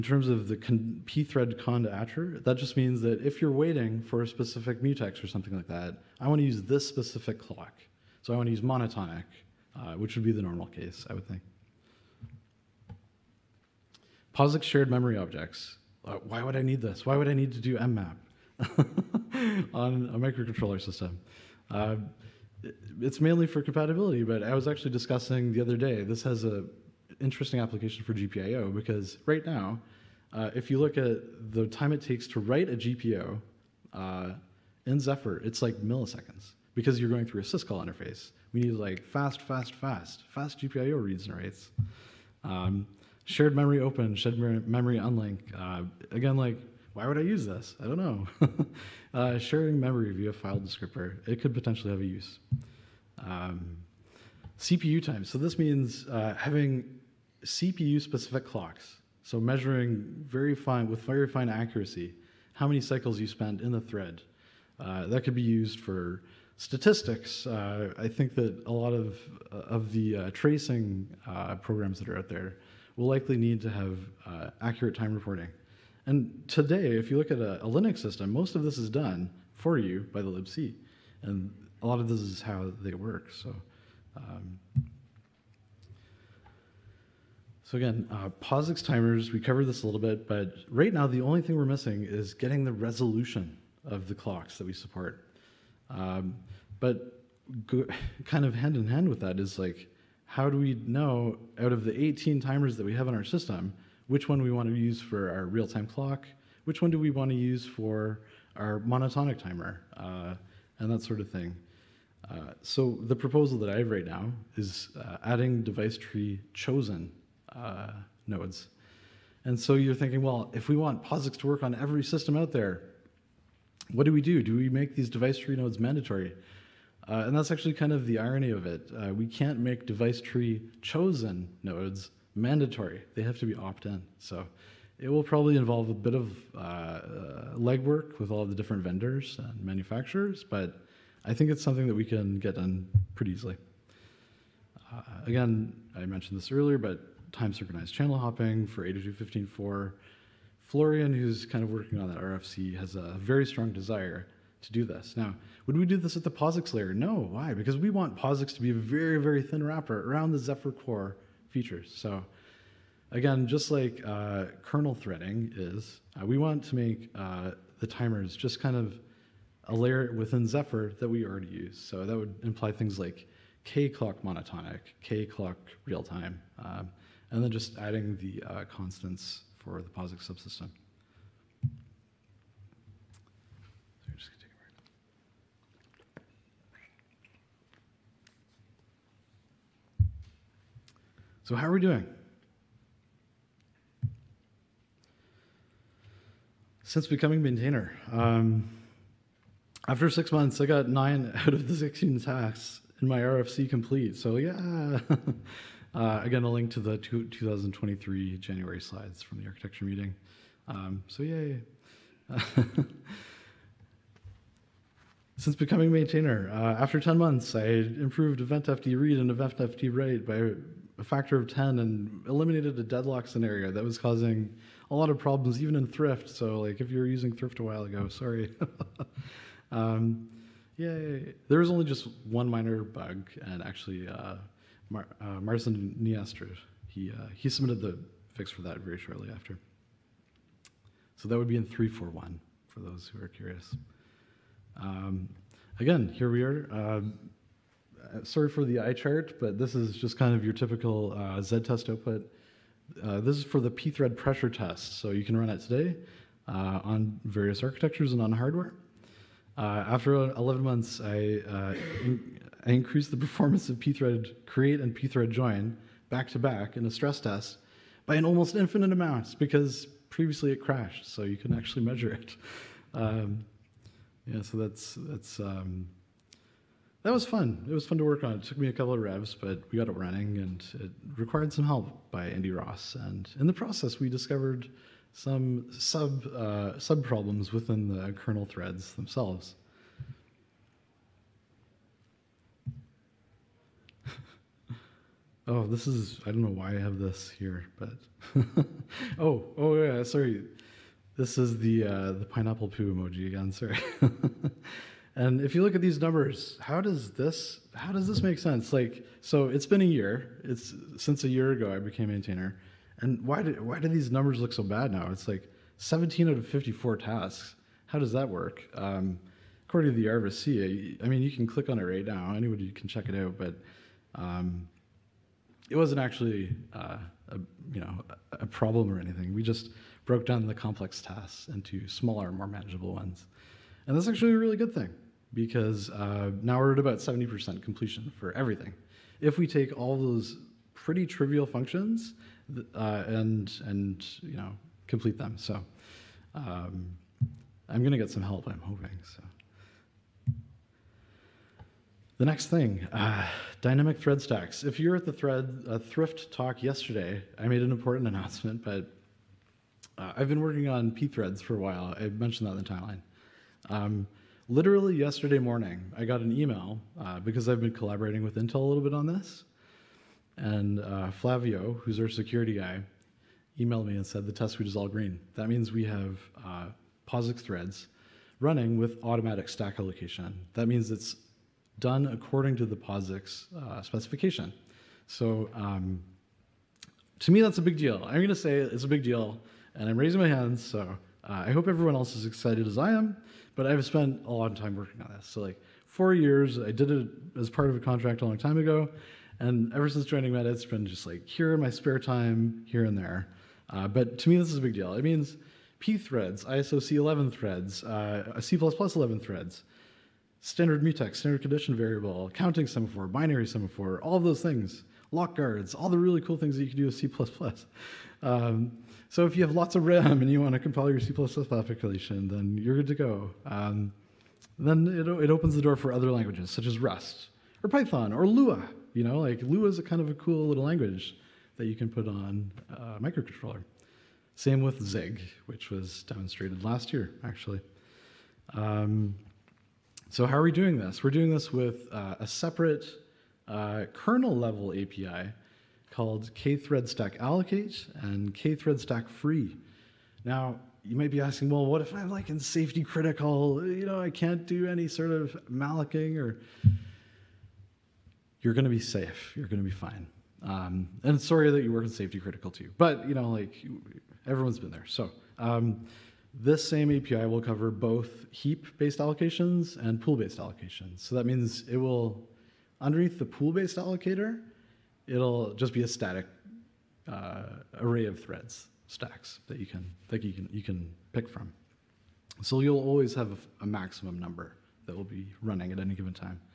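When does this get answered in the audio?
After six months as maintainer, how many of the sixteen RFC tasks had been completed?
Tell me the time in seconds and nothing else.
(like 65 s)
200 s.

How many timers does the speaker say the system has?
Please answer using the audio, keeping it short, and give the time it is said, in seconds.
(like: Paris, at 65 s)
18, at 102 s.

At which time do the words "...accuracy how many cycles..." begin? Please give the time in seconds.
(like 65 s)
61 s.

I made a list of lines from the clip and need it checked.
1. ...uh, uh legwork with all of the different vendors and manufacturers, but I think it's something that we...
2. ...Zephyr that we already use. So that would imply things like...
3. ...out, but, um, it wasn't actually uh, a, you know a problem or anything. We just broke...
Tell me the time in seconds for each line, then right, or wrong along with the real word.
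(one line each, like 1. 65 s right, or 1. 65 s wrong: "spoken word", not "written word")
1. 136 s right
2. 170 s right
3. 323 s right.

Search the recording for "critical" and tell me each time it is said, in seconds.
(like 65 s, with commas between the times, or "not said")
452 s, 462 s.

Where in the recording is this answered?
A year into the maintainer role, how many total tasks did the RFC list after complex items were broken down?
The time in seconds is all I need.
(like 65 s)
316 s.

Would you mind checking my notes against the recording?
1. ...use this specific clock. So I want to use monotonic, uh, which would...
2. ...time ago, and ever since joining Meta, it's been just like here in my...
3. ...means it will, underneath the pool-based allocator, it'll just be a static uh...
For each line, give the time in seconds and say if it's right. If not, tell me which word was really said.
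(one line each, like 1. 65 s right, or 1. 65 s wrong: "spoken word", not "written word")
1. 6 s right
2. 398 s right
3. 471 s right.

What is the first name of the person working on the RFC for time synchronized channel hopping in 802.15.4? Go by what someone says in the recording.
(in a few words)
Florian.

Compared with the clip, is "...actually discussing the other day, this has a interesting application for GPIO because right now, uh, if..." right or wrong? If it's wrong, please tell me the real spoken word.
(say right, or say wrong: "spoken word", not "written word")
right.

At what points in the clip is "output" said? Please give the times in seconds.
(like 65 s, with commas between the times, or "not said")
251 s.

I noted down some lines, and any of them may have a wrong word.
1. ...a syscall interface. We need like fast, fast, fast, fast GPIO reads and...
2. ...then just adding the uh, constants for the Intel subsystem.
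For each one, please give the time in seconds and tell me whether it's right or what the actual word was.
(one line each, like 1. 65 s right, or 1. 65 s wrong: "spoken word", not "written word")
1. 37 s right
2. 177 s wrong: "POSIX", not "Intel".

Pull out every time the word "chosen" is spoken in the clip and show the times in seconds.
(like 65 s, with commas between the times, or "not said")
116 s, 130 s.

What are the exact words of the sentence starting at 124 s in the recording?
Do we make these device tree nodes mandatory?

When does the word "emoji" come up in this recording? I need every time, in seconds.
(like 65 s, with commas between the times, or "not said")
302 s.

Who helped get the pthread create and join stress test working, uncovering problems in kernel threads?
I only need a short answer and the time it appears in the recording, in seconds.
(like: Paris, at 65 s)
Andy Ross, at 282 s.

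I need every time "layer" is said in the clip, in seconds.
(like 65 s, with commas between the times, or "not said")
156 s, 169 s.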